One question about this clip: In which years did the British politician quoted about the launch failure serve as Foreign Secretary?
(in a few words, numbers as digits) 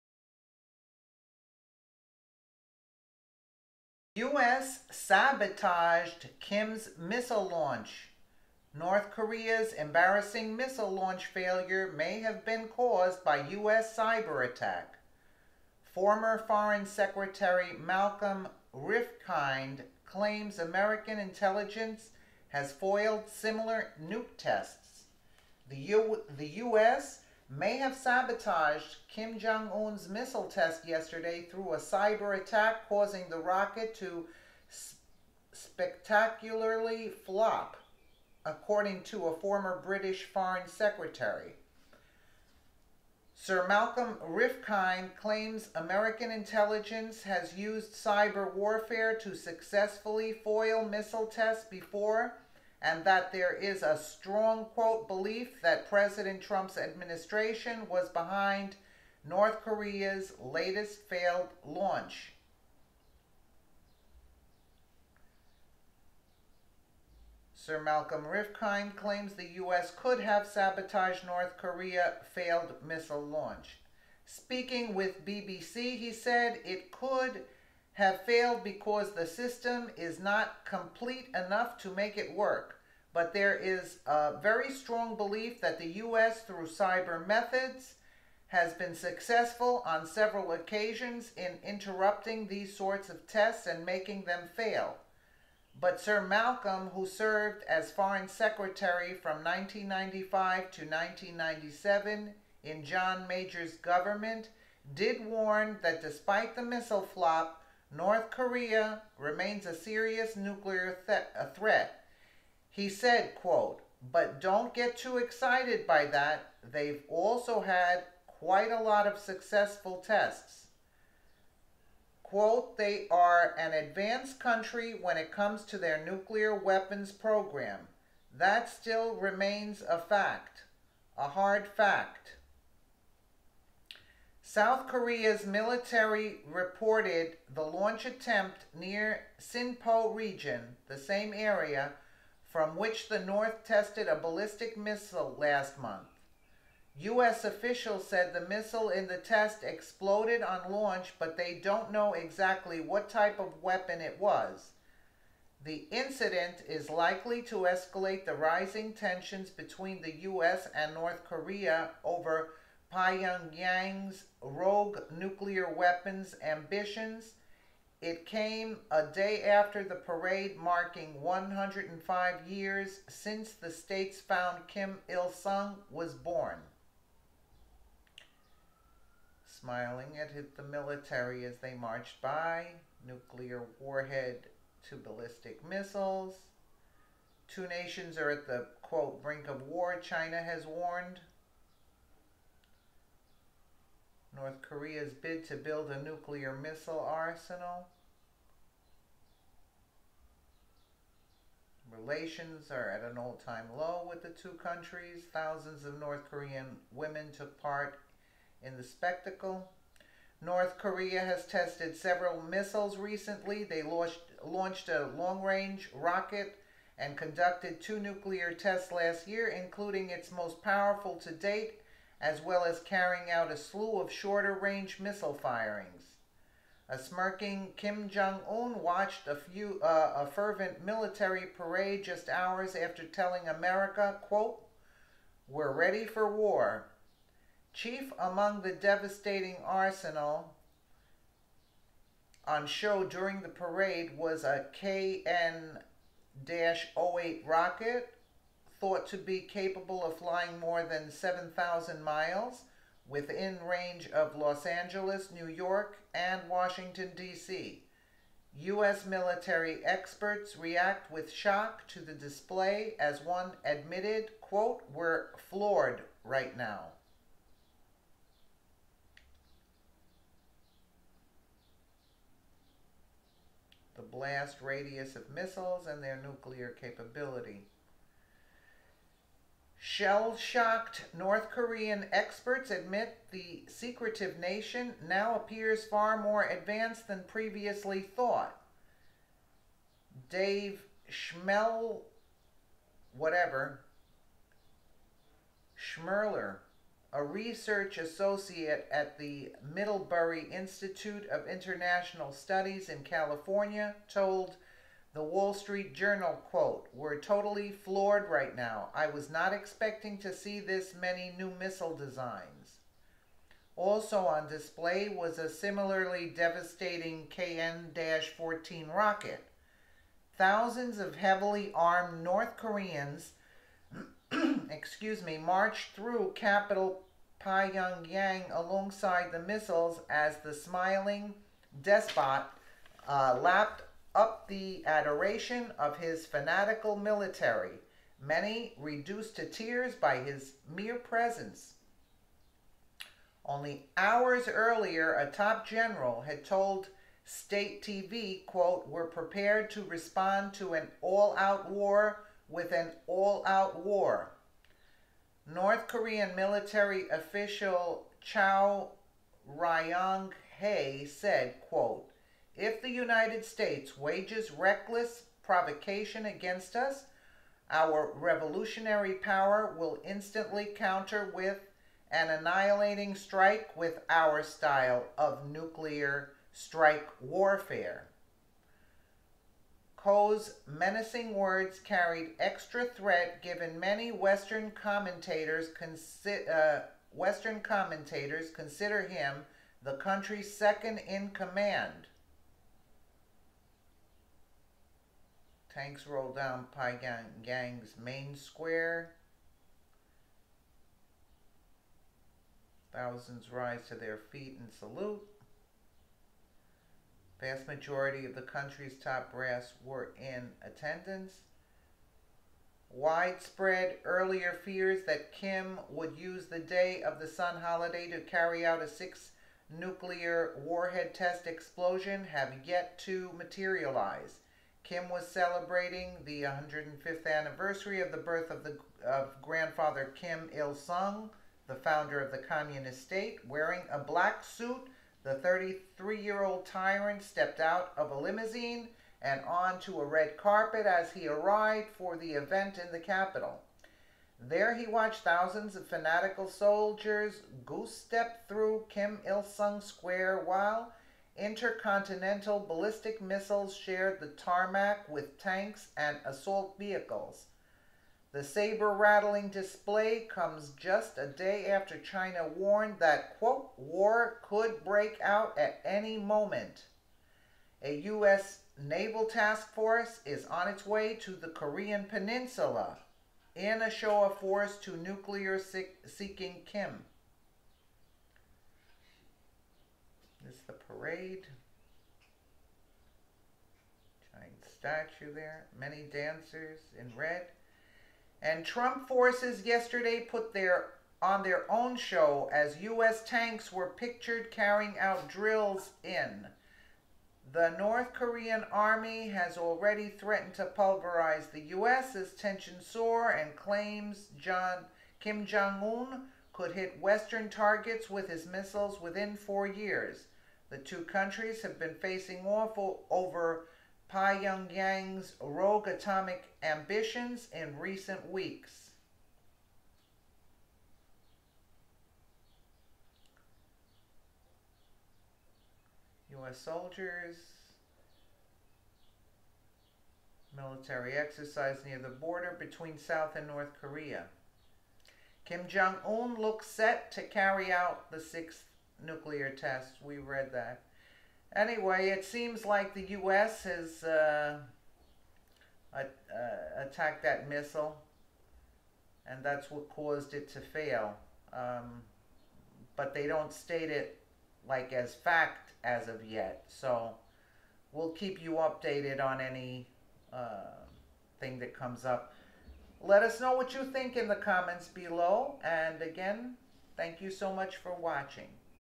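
1995 to 1997.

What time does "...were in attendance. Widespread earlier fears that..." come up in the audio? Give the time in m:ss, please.
6:49.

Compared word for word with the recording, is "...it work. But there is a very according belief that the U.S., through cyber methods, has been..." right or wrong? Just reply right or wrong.
wrong.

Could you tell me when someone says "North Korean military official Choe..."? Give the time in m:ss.
5:55.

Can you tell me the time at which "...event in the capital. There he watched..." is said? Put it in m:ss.
7:22.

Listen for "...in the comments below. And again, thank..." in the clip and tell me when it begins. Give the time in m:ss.
9:24.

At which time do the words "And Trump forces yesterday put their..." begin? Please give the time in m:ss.
8:08.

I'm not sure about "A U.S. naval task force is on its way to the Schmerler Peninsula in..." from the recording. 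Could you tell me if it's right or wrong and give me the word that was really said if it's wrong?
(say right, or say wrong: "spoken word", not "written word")
wrong: "Korean", not "Schmerler".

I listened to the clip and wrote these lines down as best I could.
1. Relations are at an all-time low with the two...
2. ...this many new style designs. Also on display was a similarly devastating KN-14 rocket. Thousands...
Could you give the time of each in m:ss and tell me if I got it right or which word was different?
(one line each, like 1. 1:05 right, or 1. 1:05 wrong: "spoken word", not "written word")
1. 3:21 right
2. 5:10 wrong: "missile", not "style".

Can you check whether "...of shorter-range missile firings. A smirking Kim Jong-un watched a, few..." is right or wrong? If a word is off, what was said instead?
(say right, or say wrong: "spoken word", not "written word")
right.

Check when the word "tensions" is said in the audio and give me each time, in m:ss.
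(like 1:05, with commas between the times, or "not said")
2:38, 8:22.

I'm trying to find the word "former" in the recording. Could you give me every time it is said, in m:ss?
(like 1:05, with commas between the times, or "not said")
0:15, 0:39.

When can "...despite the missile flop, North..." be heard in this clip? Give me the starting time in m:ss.
1:46.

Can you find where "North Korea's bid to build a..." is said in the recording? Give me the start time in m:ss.
3:14.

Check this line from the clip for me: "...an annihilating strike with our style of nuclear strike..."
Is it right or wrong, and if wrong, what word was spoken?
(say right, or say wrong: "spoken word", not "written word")
right.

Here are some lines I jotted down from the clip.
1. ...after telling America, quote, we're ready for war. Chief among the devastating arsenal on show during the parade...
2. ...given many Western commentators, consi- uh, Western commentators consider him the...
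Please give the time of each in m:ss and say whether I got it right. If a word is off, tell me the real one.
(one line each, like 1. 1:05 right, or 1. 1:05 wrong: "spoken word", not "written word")
1. 3:52 right
2. 6:23 right.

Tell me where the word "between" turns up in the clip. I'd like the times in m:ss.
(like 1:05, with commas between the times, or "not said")
2:39, 8:52.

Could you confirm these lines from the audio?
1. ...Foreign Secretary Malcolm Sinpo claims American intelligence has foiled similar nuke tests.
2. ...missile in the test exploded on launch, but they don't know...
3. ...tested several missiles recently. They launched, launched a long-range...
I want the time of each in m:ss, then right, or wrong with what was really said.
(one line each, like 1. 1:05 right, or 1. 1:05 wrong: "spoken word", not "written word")
1. 0:16 wrong: "Rifkind", not "Sinpo"
2. 2:28 right
3. 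3:31 right.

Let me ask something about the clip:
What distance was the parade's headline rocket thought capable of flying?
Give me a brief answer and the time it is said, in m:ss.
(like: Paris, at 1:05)
7,000 miles, at 4:11.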